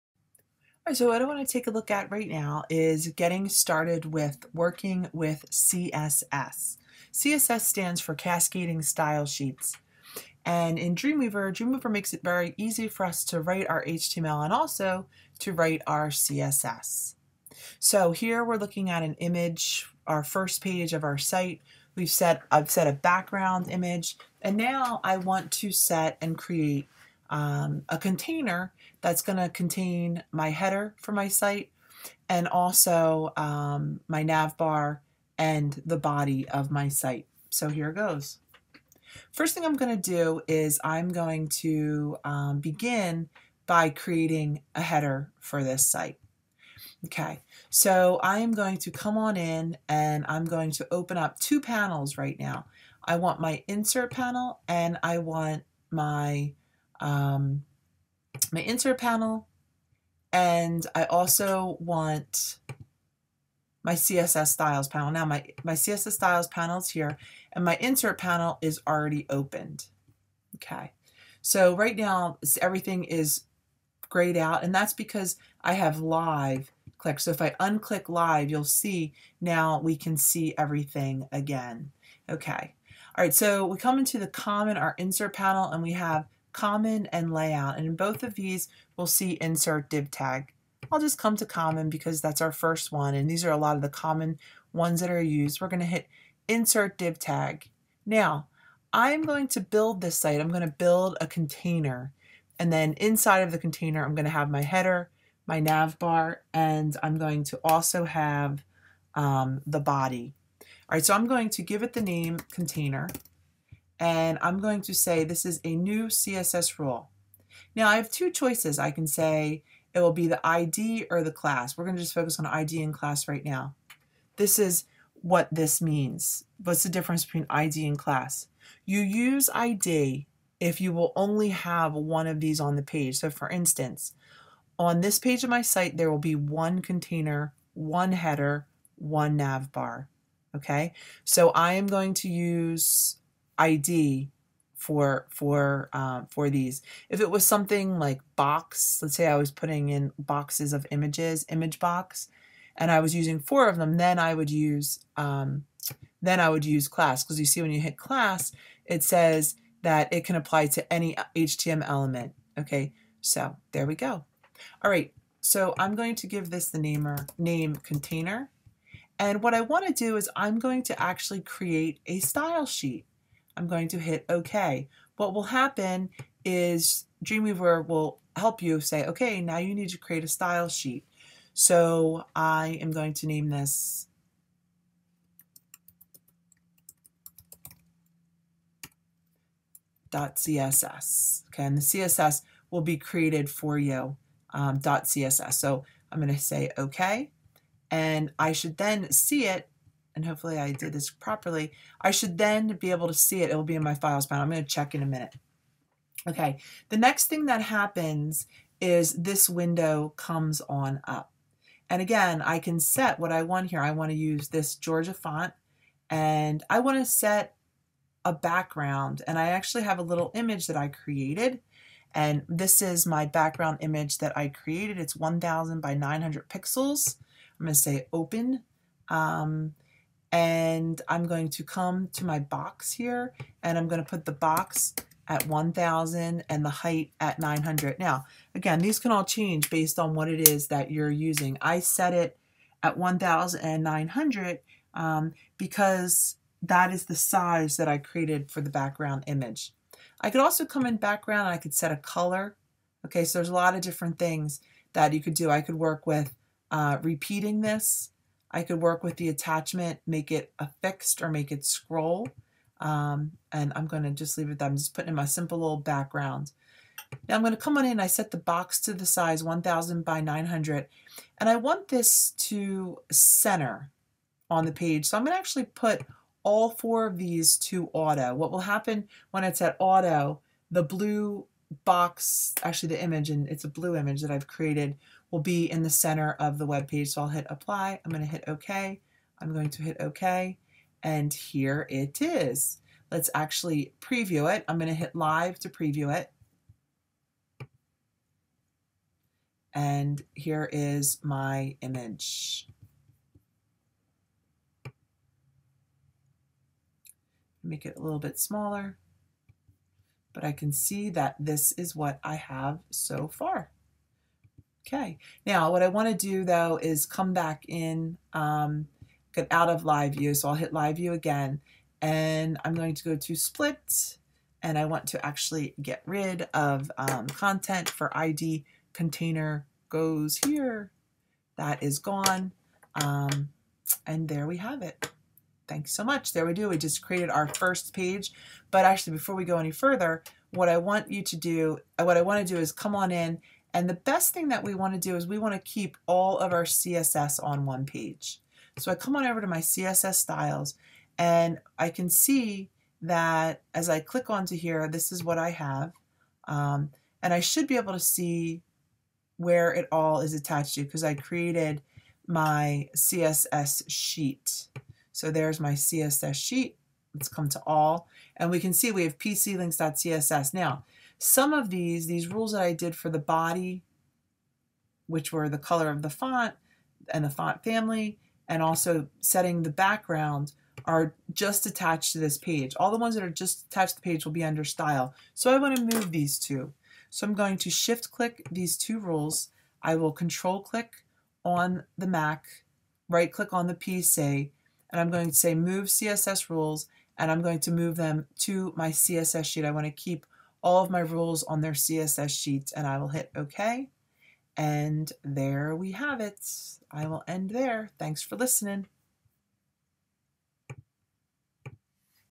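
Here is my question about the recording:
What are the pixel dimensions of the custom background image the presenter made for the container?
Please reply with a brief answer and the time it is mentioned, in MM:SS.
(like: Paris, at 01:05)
1000 by 900, at 03:45.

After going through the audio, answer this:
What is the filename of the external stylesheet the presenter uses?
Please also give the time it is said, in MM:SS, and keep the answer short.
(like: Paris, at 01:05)
pclinks.css, at 06:09.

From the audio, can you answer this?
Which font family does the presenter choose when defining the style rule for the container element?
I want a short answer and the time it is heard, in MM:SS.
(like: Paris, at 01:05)
Georgia, at 03:34.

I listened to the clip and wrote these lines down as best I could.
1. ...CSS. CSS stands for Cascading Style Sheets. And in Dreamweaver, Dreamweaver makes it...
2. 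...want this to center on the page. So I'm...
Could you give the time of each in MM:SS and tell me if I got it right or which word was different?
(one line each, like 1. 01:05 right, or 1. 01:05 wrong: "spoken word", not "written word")
1. 00:05 right
2. 04:31 right.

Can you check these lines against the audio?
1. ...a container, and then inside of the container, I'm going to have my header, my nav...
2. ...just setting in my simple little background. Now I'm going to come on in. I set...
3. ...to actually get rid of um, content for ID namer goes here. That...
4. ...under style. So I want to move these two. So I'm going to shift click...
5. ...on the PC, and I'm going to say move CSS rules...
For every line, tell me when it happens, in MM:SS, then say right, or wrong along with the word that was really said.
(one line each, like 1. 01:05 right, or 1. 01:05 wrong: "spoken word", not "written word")
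1. 01:41 right
2. 04:24 wrong: "putting", not "setting"
3. 05:25 wrong: "container", not "namer"
4. 06:24 right
5. 06:33 right.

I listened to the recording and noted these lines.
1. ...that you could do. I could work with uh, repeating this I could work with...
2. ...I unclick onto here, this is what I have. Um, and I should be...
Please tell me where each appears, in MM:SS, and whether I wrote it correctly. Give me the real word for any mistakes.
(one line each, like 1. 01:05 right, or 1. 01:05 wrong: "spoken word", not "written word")
1. 04:14 right
2. 05:53 wrong: "click", not "unclick".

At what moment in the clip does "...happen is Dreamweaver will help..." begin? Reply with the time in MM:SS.
02:55.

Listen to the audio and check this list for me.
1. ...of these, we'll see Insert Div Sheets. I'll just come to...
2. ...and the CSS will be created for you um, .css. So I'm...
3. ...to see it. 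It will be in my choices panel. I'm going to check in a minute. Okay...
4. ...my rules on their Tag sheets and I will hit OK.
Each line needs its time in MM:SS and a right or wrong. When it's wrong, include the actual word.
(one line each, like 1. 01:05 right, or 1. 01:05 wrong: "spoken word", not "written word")
1. 01:28 wrong: "Tag", not "Sheets"
2. 03:11 right
3. 03:23 wrong: "files", not "choices"
4. 06:40 wrong: "CSS", not "Tag".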